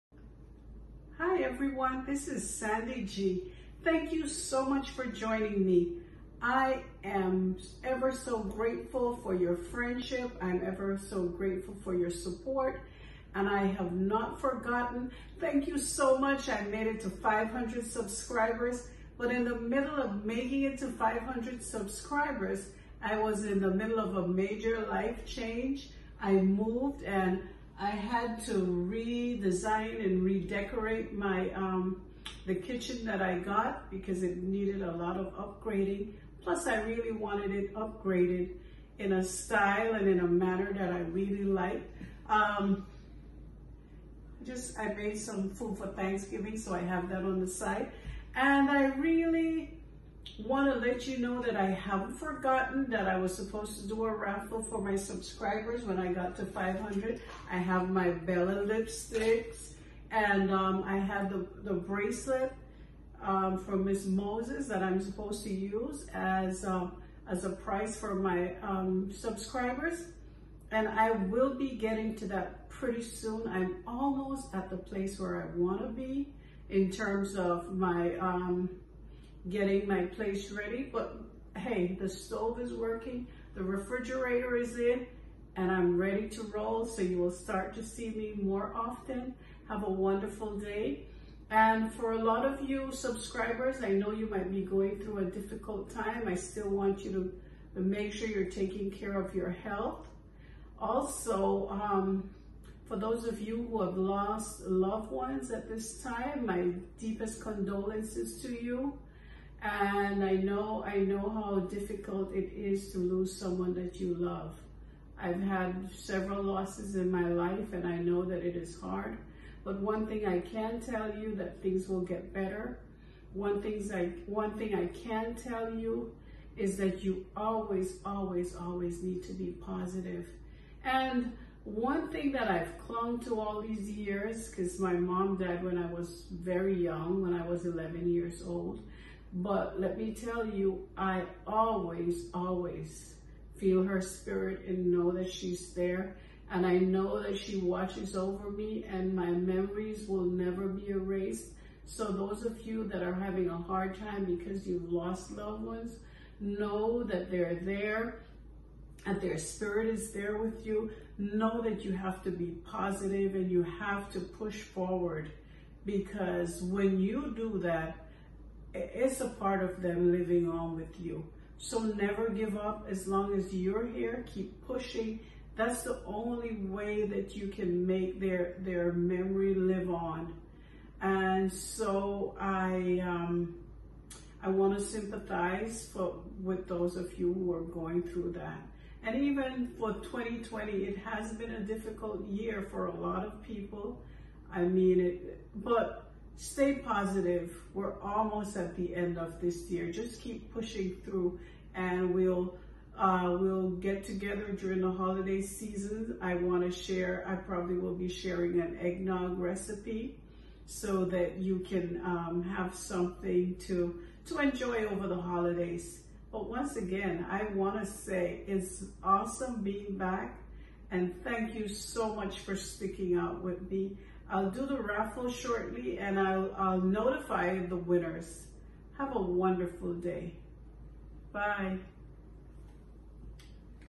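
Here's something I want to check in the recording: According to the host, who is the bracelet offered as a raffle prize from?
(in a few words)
Miss Moses.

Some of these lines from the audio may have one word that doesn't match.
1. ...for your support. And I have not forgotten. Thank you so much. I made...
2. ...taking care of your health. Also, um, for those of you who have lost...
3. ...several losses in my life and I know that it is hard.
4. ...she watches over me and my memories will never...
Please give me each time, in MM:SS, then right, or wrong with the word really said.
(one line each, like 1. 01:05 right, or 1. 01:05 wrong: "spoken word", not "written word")
1. 00:11 right
2. 01:38 right
3. 01:55 right
4. 02:27 right.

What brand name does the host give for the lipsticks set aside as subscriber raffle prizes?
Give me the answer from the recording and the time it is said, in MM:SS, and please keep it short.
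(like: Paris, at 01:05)
Bella, at 00:58.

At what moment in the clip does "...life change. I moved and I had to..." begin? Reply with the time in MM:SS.
00:24.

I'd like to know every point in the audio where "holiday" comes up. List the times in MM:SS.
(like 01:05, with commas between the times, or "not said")
03:24, 03:35.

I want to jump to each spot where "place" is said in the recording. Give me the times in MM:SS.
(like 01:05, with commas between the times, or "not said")
01:14, 01:20.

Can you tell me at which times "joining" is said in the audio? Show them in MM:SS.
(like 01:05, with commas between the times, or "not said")
00:05.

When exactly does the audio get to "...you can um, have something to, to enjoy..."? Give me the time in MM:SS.
03:31.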